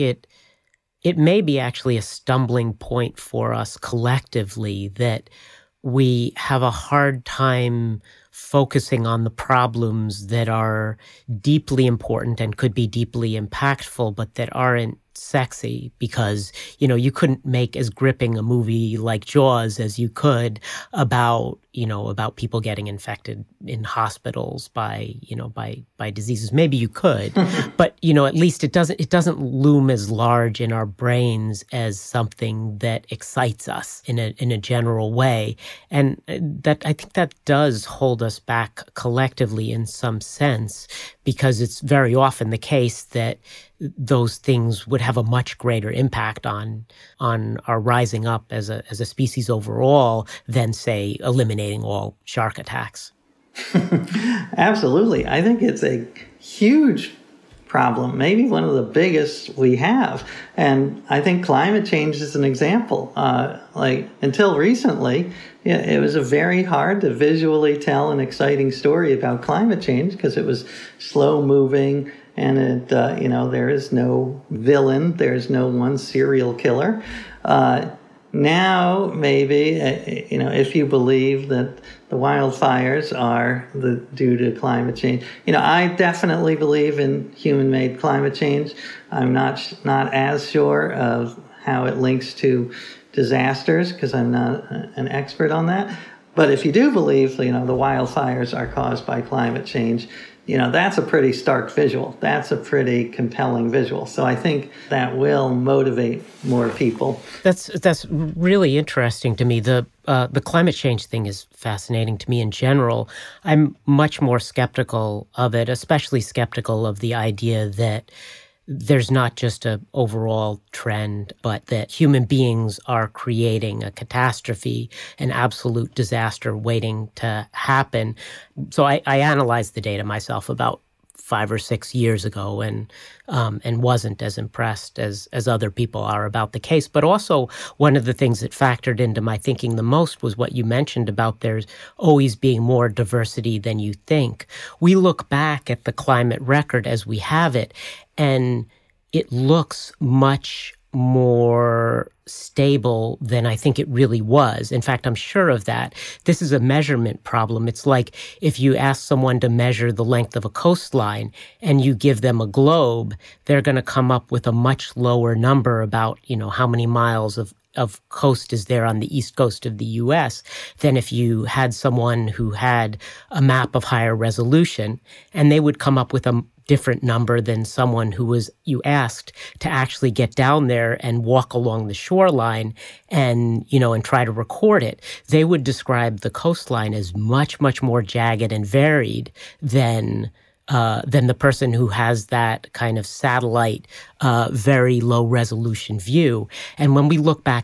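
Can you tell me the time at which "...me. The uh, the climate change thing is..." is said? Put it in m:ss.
1:49.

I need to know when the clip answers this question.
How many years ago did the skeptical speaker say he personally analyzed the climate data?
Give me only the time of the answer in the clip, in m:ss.
2:11.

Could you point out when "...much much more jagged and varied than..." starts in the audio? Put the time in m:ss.
3:07.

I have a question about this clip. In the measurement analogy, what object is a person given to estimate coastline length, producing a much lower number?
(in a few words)
A globe.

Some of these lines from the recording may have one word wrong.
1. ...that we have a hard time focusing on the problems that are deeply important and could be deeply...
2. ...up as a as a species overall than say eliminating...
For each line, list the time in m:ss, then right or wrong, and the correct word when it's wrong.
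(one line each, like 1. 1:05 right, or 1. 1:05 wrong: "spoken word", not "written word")
1. 0:04 right
2. 0:48 right.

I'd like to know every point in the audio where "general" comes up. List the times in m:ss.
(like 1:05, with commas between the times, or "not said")
0:34, 1:52.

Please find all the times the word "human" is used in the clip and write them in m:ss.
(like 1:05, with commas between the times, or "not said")
1:27, 2:01.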